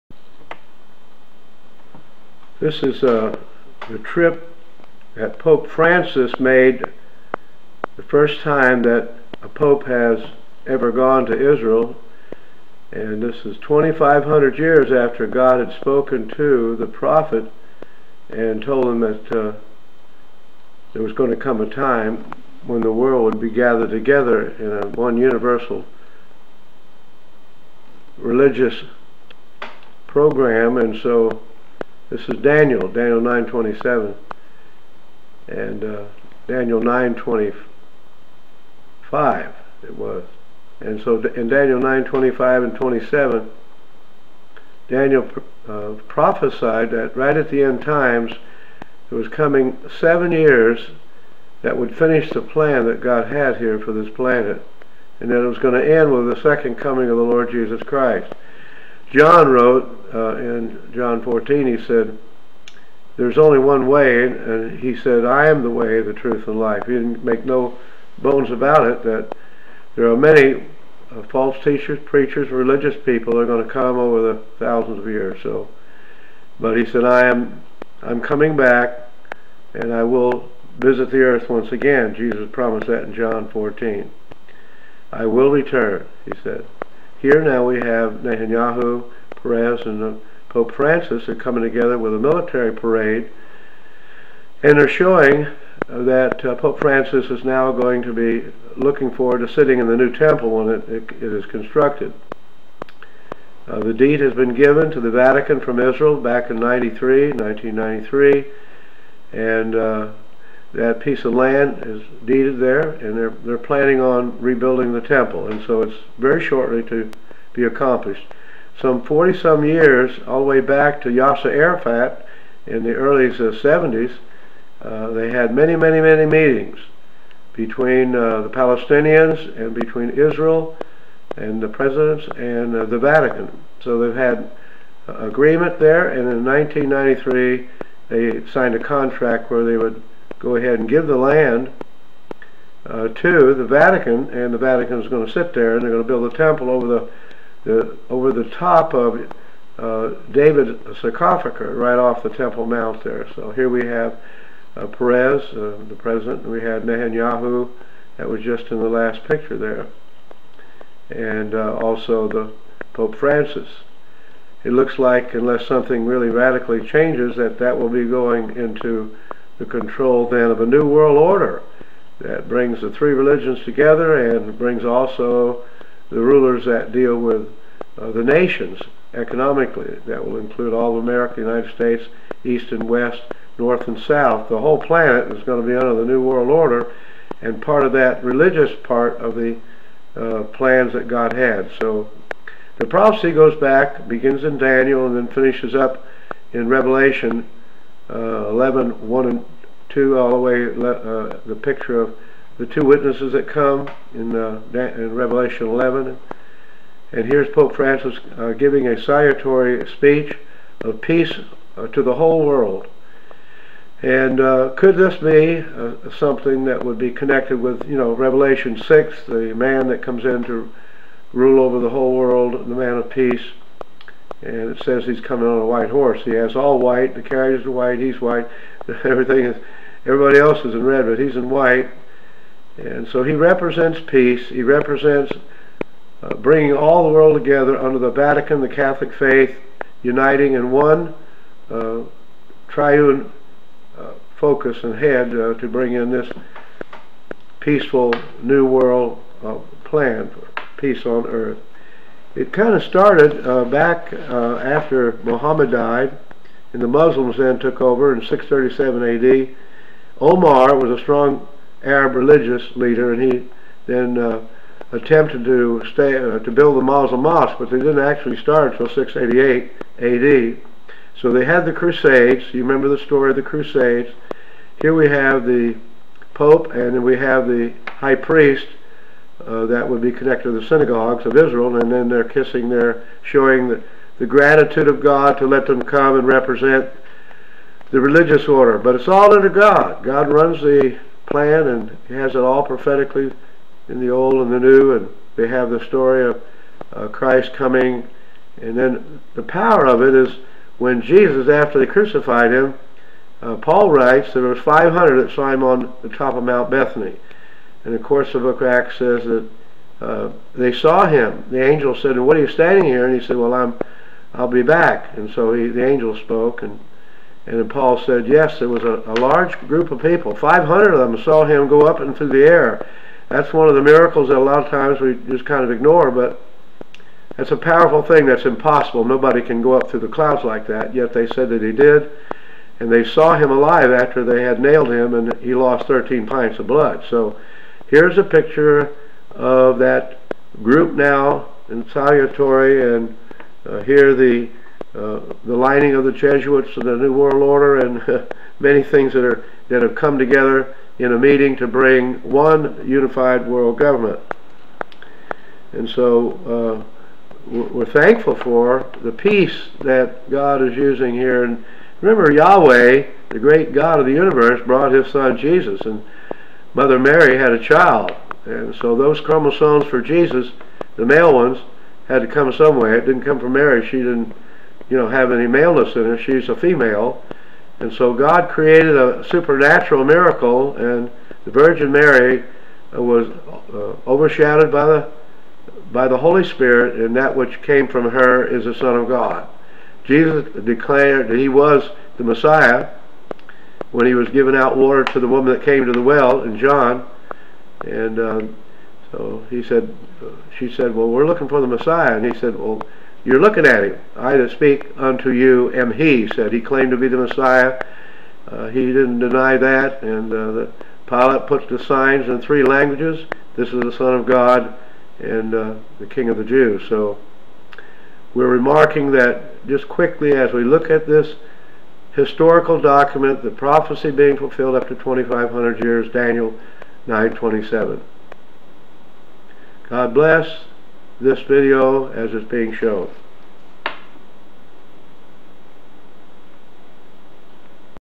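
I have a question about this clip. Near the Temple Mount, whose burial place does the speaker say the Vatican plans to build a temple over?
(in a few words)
David's sarcophagus.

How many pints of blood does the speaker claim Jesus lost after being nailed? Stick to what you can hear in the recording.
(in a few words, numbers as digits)
13.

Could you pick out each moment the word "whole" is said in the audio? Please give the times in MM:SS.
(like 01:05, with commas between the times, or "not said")
03:04, 03:32, 03:41.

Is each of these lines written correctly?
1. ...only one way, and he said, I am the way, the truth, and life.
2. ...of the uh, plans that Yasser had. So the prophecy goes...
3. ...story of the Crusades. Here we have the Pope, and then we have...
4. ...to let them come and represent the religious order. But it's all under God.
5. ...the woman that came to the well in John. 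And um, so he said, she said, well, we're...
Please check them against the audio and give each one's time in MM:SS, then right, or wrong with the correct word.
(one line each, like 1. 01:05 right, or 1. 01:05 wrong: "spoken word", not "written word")
1. 01:03 right
2. 03:09 wrong: "God", not "Yasser"
3. 04:33 right
4. 04:45 right
5. 06:35 right.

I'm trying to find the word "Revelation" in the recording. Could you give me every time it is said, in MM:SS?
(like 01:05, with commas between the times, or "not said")
03:16, 03:25, 03:38.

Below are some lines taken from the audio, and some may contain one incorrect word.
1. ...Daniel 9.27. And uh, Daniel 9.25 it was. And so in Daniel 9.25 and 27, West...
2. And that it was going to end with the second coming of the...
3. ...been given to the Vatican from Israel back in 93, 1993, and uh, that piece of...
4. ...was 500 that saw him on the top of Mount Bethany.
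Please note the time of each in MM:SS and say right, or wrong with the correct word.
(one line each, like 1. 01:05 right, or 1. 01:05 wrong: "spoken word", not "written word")
1. 00:32 wrong: "Daniel", not "West"
2. 00:55 right
3. 01:44 right
4. 05:04 right.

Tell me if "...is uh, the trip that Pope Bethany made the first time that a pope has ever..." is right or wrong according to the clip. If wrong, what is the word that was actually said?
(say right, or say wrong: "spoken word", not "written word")
wrong: "Francis", not "Bethany".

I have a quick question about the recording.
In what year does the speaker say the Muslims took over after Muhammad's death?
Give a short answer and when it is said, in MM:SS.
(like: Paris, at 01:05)
637 AD, at 04:18.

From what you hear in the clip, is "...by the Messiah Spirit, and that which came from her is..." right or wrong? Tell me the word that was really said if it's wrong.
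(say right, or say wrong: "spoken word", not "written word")
wrong: "Holy", not "Messiah".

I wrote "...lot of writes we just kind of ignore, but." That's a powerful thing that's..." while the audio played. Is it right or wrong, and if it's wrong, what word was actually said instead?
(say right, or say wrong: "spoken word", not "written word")
wrong: "times", not "writes".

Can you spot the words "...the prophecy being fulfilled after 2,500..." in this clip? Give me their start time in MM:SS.
07:03.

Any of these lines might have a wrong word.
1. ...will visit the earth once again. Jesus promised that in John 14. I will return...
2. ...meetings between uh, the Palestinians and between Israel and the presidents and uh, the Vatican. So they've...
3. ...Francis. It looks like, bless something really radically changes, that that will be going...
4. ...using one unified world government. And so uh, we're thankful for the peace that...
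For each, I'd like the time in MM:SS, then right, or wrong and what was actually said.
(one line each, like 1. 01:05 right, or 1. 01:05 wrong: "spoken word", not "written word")
1. 01:20 right
2. 02:06 right
3. 02:43 wrong: "unless", not "bless"
4. 05:51 wrong: "bring", not "using".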